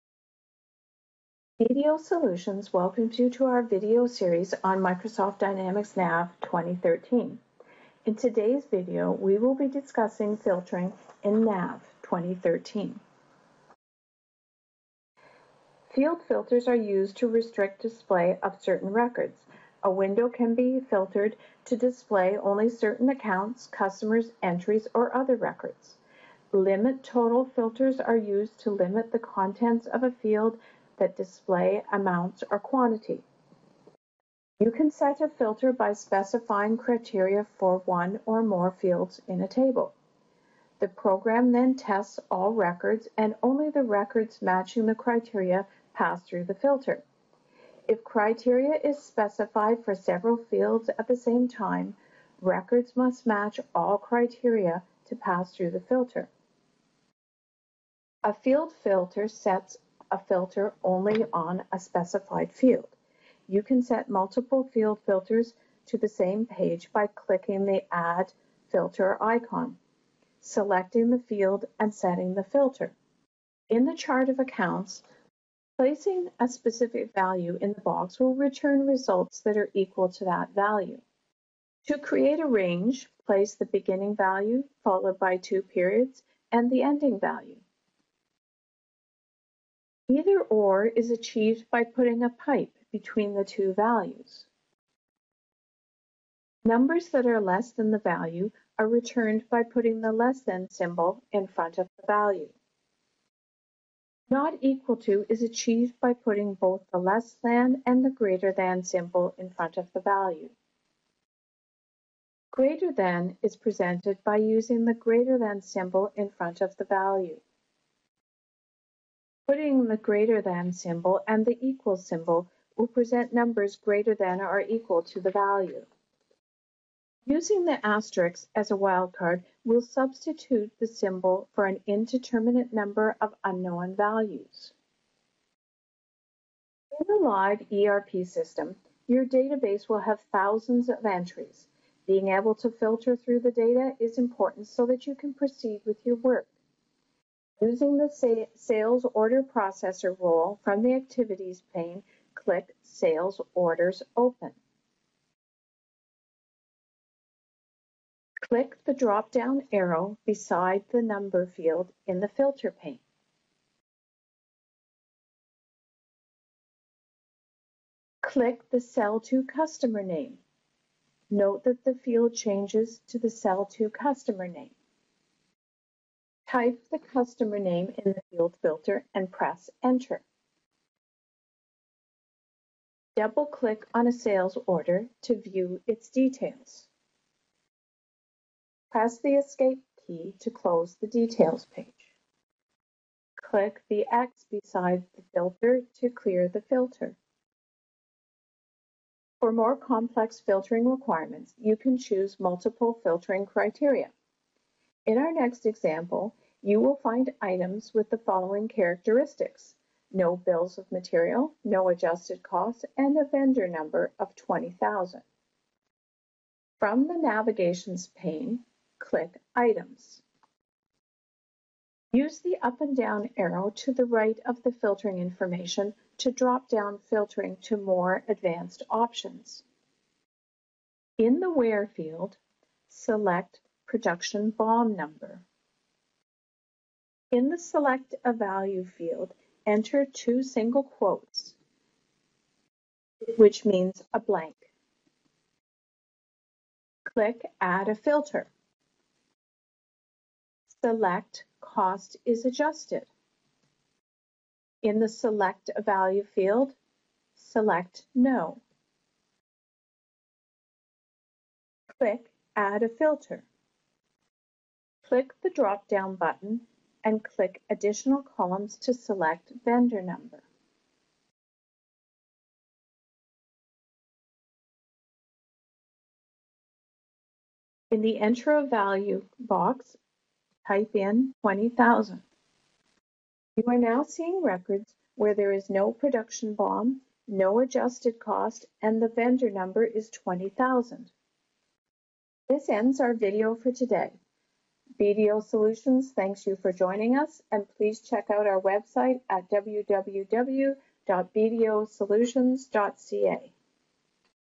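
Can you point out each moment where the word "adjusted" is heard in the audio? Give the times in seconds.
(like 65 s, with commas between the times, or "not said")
211 s, 252 s, 287 s.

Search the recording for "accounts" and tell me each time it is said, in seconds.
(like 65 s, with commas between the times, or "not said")
23 s, 74 s.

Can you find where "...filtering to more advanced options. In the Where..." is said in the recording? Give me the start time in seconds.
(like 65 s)
226 s.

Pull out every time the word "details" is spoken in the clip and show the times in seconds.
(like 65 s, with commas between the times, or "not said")
186 s, 191 s.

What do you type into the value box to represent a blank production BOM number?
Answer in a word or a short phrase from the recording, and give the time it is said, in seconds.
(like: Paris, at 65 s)
two single quotes, at 240 s.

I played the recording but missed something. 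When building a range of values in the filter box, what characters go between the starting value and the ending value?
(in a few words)
two periods.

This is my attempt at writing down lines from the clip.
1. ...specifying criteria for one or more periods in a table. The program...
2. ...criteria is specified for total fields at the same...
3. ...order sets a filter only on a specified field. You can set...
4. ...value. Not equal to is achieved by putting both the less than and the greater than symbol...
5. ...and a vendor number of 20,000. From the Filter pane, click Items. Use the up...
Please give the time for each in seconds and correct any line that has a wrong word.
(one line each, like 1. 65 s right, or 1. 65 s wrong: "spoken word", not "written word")
1. 35 s wrong: "fields", not "periods"
2. 48 s wrong: "several", not "total"
3. 58 s wrong: "filter", not "order"
4. 102 s right
5. 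212 s wrong: "Navigations", not "Filter".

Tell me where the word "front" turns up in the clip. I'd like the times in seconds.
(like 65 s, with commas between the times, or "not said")
101 s, 109 s, 116 s.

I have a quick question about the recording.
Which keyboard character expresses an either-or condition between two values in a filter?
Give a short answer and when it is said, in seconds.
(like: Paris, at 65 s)
pipe, at 92 s.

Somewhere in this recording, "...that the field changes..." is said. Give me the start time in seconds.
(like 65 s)
171 s.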